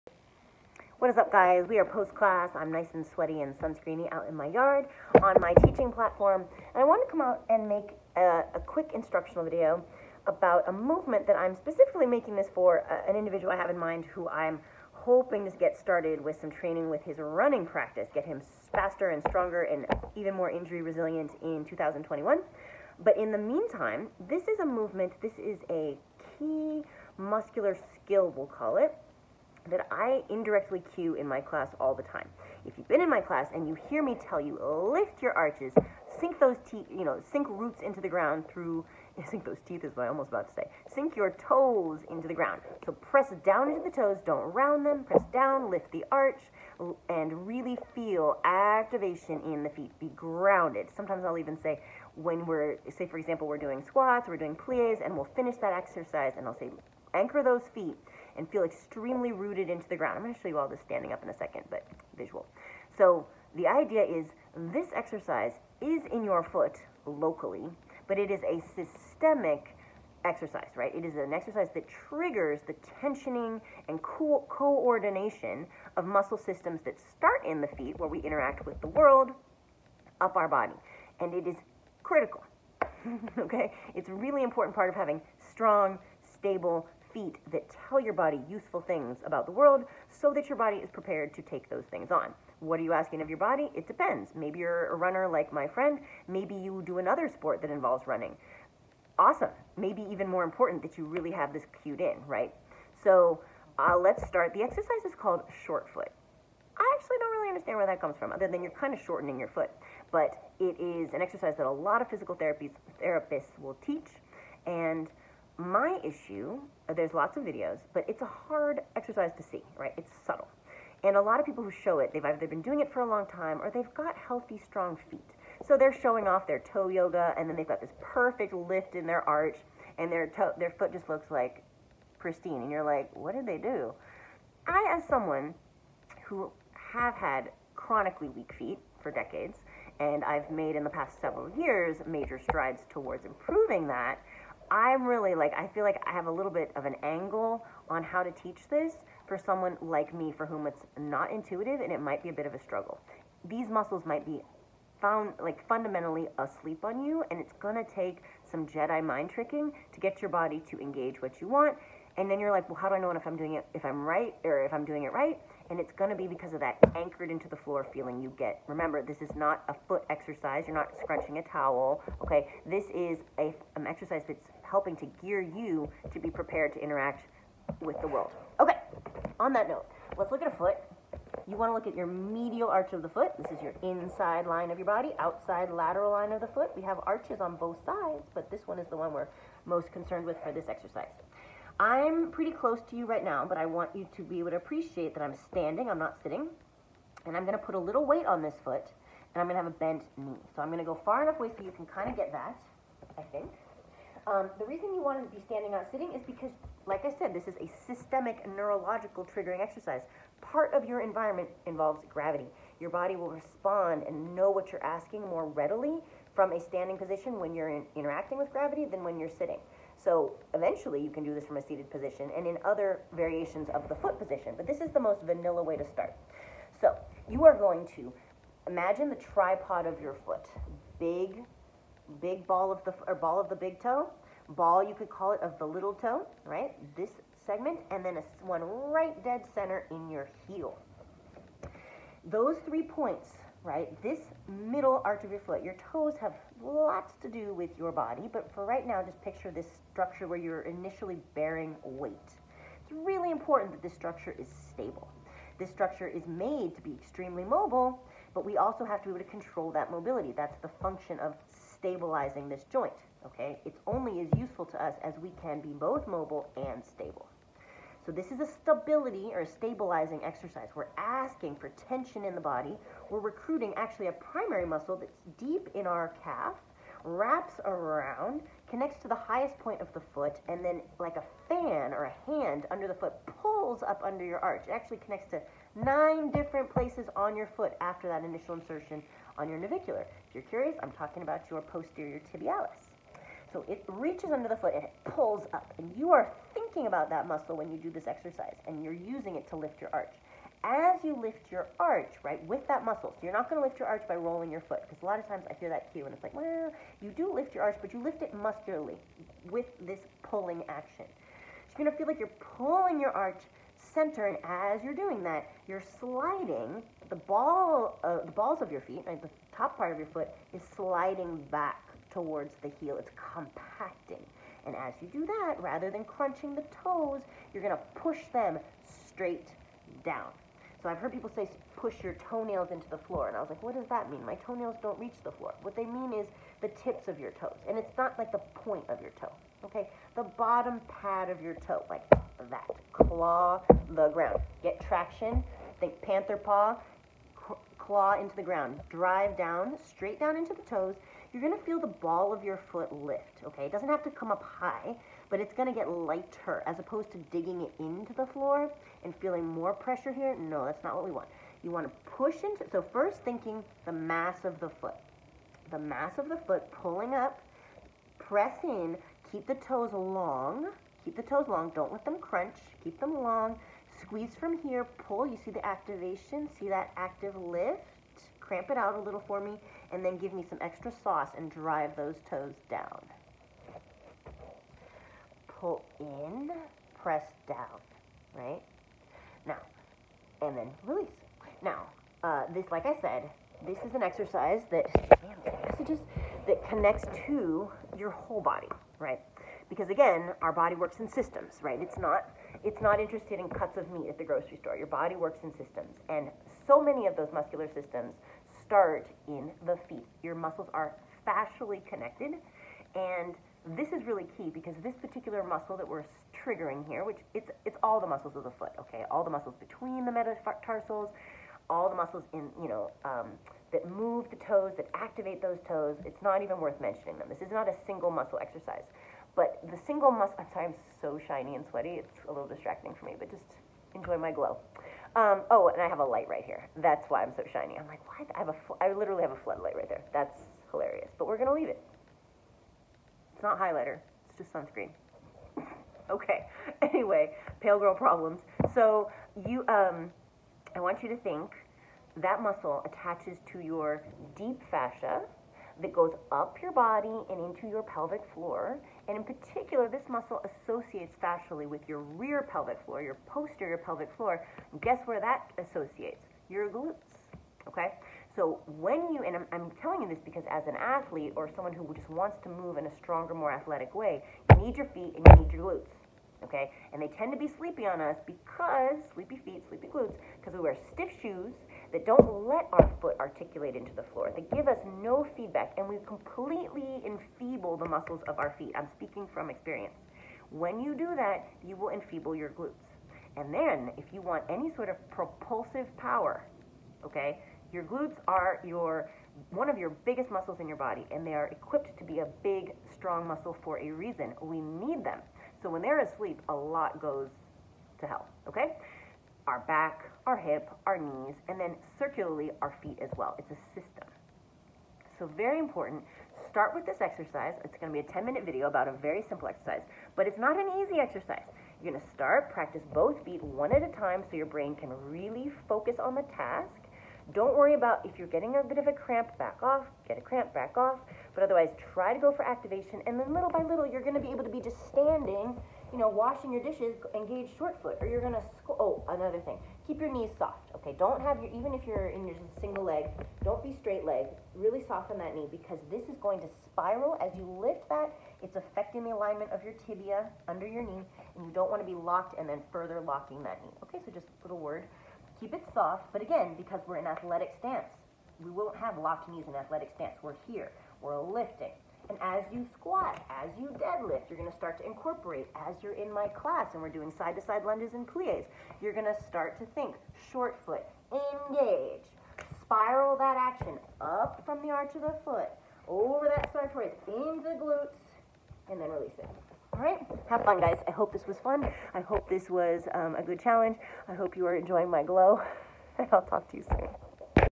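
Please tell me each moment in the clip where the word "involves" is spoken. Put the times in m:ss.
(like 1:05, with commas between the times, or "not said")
1:37, 3:31.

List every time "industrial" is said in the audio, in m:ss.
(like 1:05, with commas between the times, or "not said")
not said.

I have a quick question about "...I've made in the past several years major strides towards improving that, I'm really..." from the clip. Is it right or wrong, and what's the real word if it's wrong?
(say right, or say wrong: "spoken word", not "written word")
right.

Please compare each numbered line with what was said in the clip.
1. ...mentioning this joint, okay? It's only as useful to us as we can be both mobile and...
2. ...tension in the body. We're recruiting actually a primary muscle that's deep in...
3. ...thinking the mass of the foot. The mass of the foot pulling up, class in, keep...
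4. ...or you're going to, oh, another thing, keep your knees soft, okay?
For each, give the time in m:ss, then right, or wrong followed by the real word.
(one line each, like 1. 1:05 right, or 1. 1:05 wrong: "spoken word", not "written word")
1. 4:21 wrong: "stabilizing", not "mentioning"
2. 4:31 right
3. 6:03 wrong: "press", not "class"
4. 8:58 right.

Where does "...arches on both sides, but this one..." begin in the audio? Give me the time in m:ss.
3:07.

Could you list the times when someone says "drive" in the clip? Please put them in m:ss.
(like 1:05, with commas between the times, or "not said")
5:48, 6:21.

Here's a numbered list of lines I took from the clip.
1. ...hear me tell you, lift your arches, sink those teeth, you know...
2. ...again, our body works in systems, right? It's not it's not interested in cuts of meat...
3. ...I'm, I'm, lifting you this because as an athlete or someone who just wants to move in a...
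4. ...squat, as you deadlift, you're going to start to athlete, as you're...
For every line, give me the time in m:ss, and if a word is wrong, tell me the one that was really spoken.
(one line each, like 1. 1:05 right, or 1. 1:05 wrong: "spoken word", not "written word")
1. 0:33 right
2. 6:39 right
3. 7:49 wrong: "telling", not "lifting"
4. 9:22 wrong: "incorporate", not "athlete".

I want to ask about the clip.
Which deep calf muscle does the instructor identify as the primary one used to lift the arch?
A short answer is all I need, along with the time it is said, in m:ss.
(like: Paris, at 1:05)
Posterior tibialis, at 4:51.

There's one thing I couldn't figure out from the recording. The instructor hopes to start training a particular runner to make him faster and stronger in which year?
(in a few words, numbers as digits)
2021.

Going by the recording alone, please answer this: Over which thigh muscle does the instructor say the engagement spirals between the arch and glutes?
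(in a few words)
Sartorius.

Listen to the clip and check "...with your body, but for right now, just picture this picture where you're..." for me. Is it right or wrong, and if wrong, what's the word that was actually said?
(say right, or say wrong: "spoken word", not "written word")
wrong: "structure", not "picture".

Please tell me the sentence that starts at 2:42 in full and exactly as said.
And then you're like, well, how do I know if I'm doing it if I'm right or if I'm doing it right?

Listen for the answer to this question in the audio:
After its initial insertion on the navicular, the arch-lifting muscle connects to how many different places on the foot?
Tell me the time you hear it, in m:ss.
4:45.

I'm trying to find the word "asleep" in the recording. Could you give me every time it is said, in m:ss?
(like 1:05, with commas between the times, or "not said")
2:36, 8:26.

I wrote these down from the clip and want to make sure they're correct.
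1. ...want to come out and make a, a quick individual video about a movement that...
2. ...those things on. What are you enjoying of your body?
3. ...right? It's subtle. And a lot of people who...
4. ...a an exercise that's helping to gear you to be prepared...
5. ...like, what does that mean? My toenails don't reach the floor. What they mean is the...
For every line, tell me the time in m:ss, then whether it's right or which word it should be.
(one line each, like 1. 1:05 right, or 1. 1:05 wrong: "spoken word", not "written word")
1. 0:06 wrong: "instructional", not "individual"
2. 1:31 wrong: "asking", not "enjoying"
3. 1:59 right
4. 2:53 right
5. 5:33 right.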